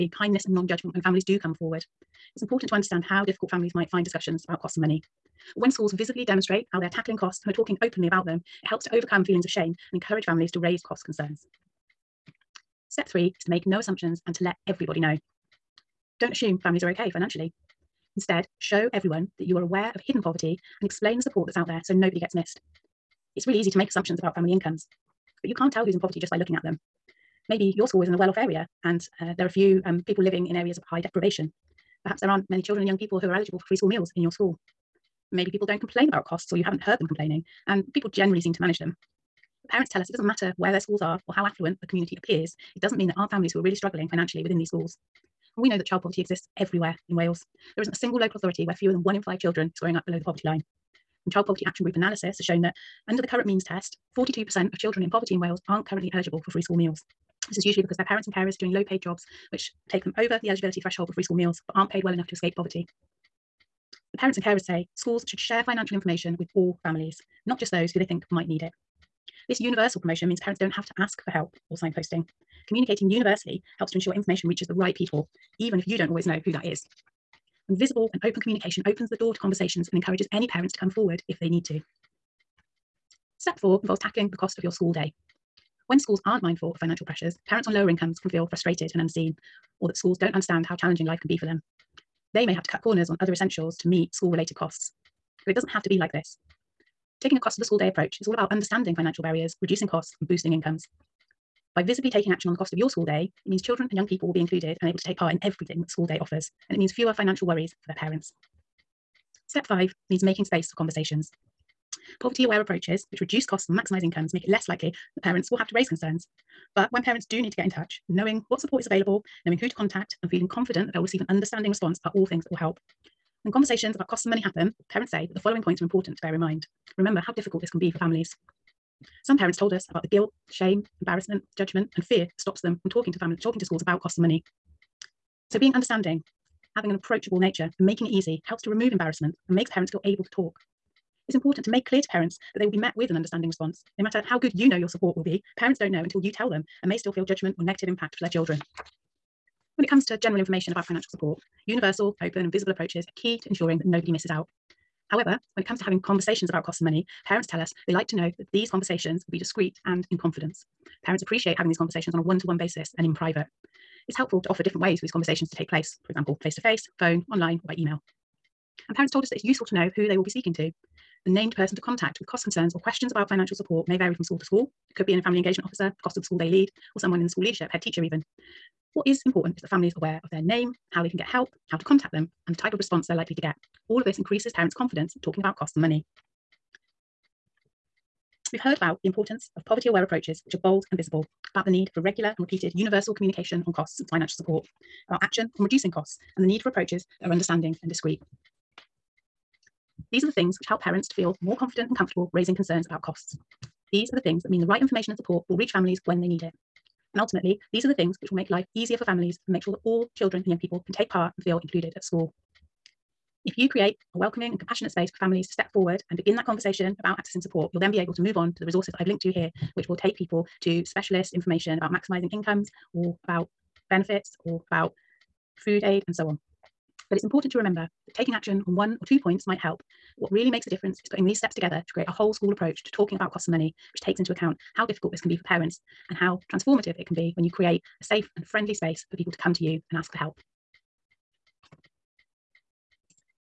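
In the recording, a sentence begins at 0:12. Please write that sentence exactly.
Step three is to make no assumptions and to let everybody know.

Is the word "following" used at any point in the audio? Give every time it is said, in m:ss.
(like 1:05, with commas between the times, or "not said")
2:05.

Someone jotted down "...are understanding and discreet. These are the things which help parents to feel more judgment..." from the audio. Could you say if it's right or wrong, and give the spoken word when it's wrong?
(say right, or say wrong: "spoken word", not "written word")
wrong: "confident", not "judgment".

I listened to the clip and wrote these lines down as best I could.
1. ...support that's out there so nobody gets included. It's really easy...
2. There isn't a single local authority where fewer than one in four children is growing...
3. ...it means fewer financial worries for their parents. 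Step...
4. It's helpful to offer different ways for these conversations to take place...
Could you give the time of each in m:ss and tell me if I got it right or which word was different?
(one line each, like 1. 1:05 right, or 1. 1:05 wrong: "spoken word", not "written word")
1. 0:21 wrong: "missed", not "included"
2. 0:47 wrong: "five", not "four"
3. 1:46 right
4. 2:44 right.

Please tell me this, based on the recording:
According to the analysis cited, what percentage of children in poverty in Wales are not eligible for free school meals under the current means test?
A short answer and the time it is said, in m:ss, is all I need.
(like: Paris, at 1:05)
42%, at 0:54.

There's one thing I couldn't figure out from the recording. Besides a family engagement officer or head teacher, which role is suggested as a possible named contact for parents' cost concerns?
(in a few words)
cost of the school day lead.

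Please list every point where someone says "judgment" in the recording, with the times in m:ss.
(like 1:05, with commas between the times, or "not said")
0:00, 2:11, 2:27.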